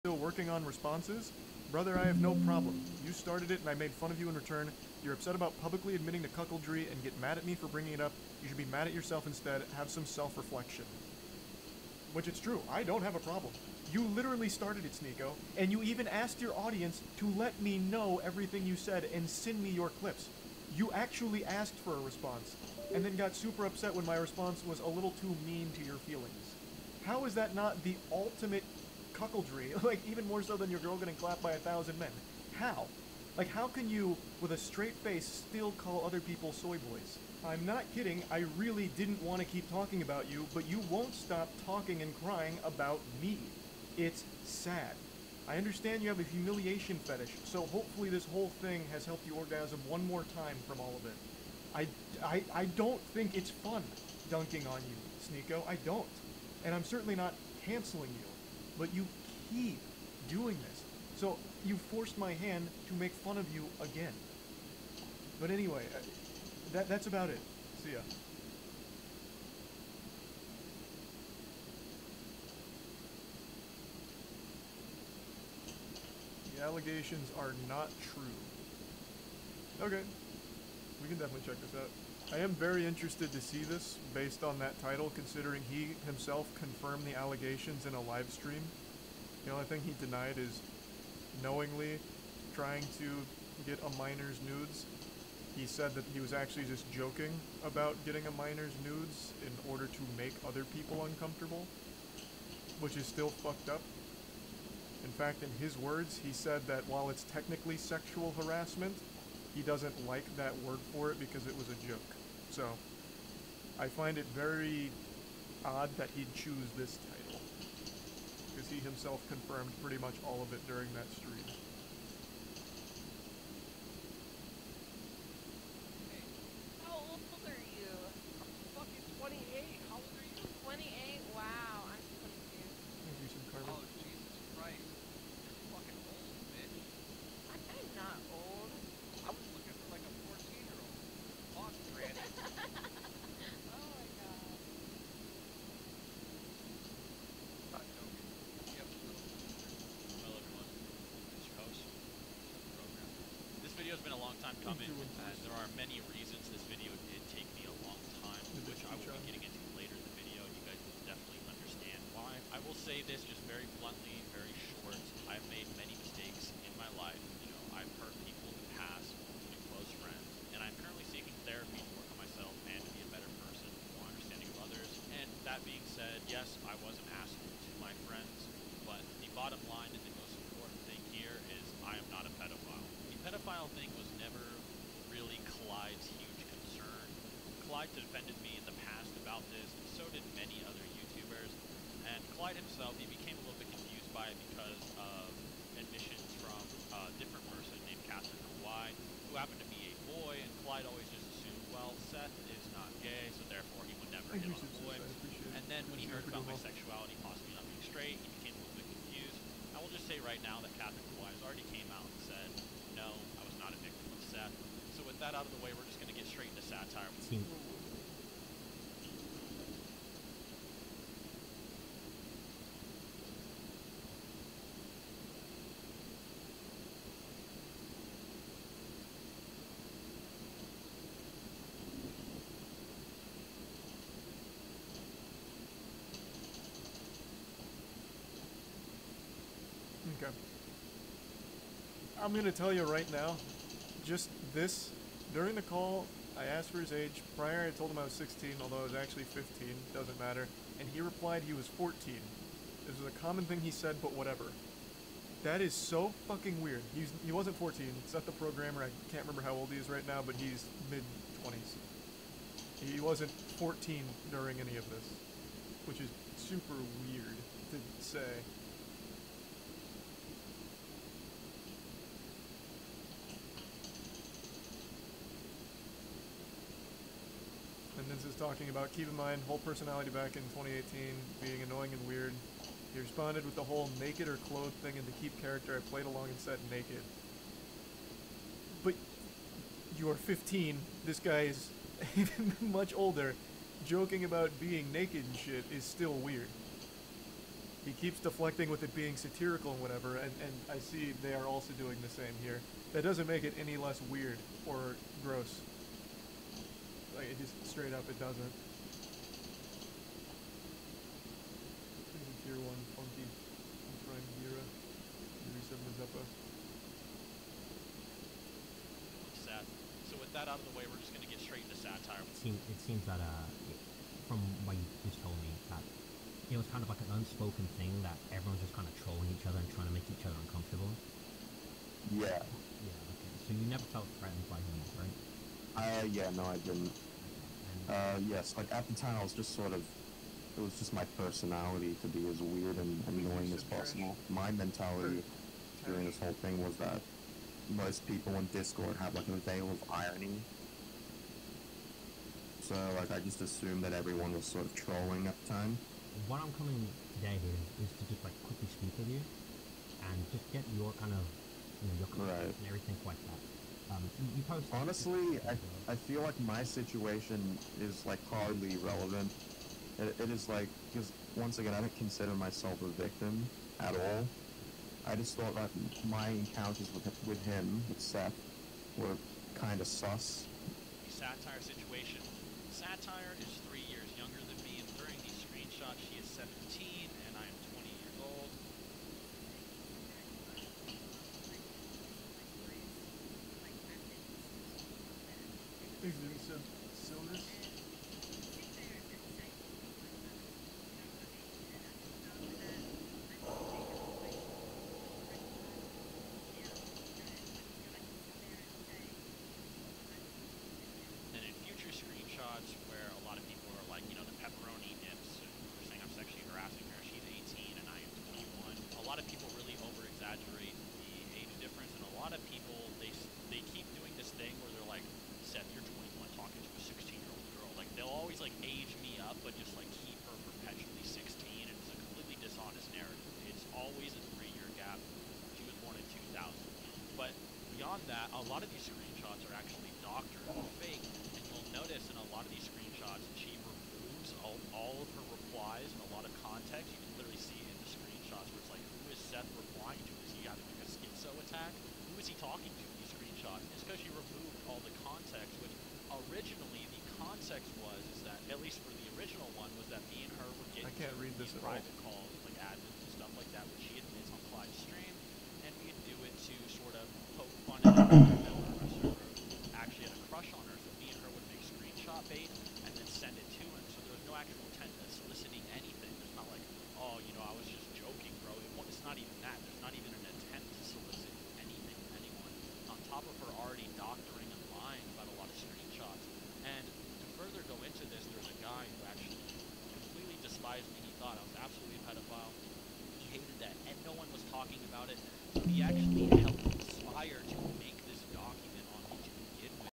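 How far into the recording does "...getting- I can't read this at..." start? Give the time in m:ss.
7:40.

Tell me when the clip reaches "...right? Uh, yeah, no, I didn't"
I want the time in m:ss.
5:34.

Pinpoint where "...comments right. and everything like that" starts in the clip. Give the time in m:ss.
6:02.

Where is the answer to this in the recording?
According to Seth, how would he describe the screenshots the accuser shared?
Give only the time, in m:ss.
7:20.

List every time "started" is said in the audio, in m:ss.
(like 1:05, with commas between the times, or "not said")
0:03, 0:14.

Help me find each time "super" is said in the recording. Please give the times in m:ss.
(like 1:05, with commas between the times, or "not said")
0:23, 4:26.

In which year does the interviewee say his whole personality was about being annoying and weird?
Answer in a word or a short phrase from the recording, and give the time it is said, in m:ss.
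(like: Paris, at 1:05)
2018, at 4:40.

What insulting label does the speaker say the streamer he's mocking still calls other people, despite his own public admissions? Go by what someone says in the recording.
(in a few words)
soy boys.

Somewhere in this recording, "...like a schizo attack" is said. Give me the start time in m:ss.
7:30.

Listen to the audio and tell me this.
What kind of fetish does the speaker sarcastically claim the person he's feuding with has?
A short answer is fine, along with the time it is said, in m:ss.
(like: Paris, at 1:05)
humiliation fetish, at 0:46.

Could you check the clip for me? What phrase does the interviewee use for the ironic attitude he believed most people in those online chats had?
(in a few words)
veil of irony.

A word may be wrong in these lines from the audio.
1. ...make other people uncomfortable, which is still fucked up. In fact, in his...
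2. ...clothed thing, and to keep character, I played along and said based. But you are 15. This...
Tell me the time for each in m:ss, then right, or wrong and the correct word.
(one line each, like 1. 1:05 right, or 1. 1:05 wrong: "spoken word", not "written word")
1. 1:40 right
2. 4:44 wrong: "naked", not "based".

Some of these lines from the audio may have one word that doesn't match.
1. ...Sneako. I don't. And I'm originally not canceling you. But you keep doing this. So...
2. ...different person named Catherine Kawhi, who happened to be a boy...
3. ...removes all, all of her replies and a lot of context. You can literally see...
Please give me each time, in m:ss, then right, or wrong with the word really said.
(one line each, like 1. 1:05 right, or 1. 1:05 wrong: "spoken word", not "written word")
1. 0:55 wrong: "certainly", not "originally"
2. 3:17 right
3. 7:23 right.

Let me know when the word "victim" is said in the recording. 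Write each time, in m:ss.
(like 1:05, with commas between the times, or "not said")
3:33, 6:13.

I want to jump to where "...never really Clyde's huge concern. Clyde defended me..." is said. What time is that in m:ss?
3:04.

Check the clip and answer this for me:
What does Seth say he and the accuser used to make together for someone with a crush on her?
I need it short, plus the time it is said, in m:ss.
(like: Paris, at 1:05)
screenshot bait, at 7:51.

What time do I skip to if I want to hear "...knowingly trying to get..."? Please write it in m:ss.
1:31.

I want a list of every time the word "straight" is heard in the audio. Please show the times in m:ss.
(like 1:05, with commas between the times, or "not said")
0:34, 3:27, 3:36, 5:07, 5:21.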